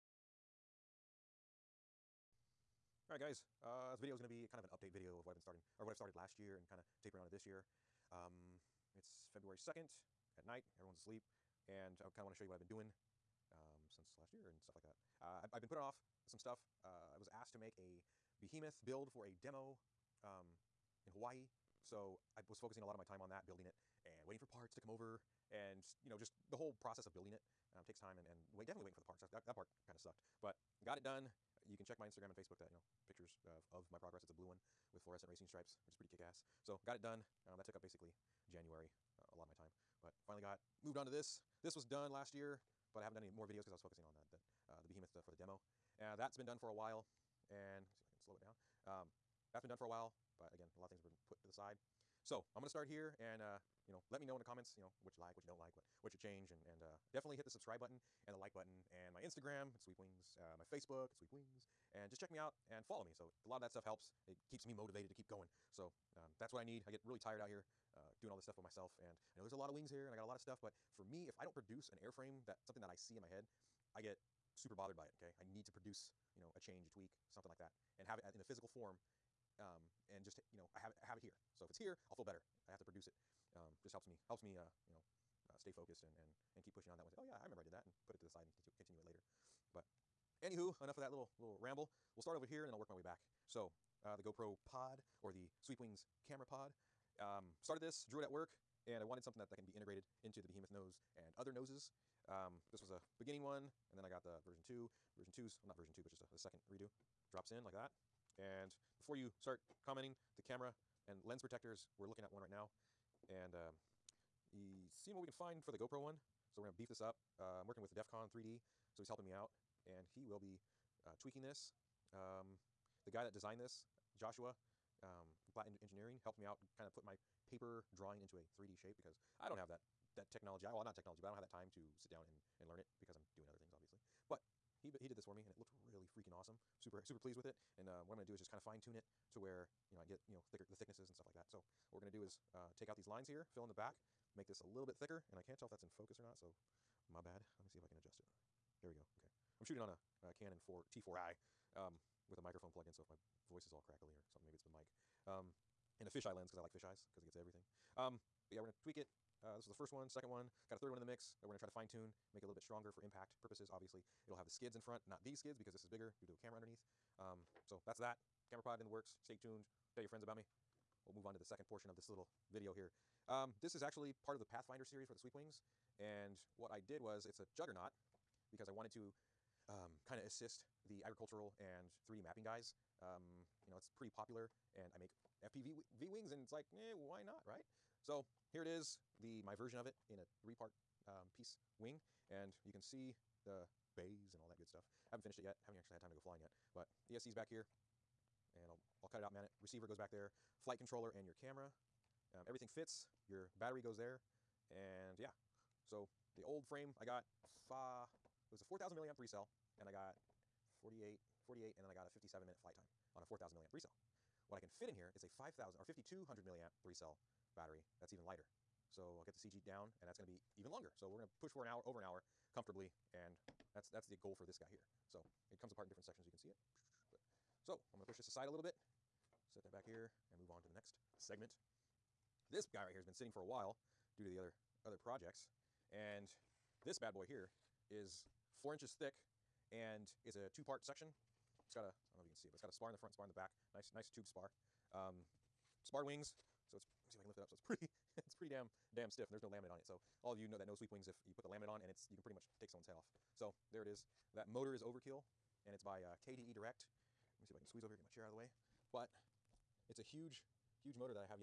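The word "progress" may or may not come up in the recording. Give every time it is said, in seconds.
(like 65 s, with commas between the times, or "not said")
33 s.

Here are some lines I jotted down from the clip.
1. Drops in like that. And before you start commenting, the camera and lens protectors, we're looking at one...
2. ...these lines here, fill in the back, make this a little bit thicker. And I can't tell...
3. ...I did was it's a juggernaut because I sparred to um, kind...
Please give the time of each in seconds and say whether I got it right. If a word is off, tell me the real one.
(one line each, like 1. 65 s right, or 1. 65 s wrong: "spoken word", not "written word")
1. 107 s right
2. 142 s right
3. 176 s wrong: "wanted", not "sparred".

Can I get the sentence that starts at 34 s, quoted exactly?
It's a blue one with fluorescent racing stripes, which is pretty kick-ass.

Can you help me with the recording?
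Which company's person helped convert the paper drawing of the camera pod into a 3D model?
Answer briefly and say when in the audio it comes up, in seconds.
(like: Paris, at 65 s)
Platt Engineering, at 125 s.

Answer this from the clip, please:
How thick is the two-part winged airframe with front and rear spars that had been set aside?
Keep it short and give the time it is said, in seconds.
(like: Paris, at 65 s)
4 inches, at 238 s.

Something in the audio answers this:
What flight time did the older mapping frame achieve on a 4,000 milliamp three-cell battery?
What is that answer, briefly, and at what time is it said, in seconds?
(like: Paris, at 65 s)
57 minutes, at 212 s.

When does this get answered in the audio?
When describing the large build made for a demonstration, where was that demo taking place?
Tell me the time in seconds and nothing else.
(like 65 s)
21 s.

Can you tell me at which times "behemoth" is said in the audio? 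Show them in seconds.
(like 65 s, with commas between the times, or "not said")
18 s, 44 s, 100 s.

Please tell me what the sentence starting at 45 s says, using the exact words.
Uh, that's been done for a while.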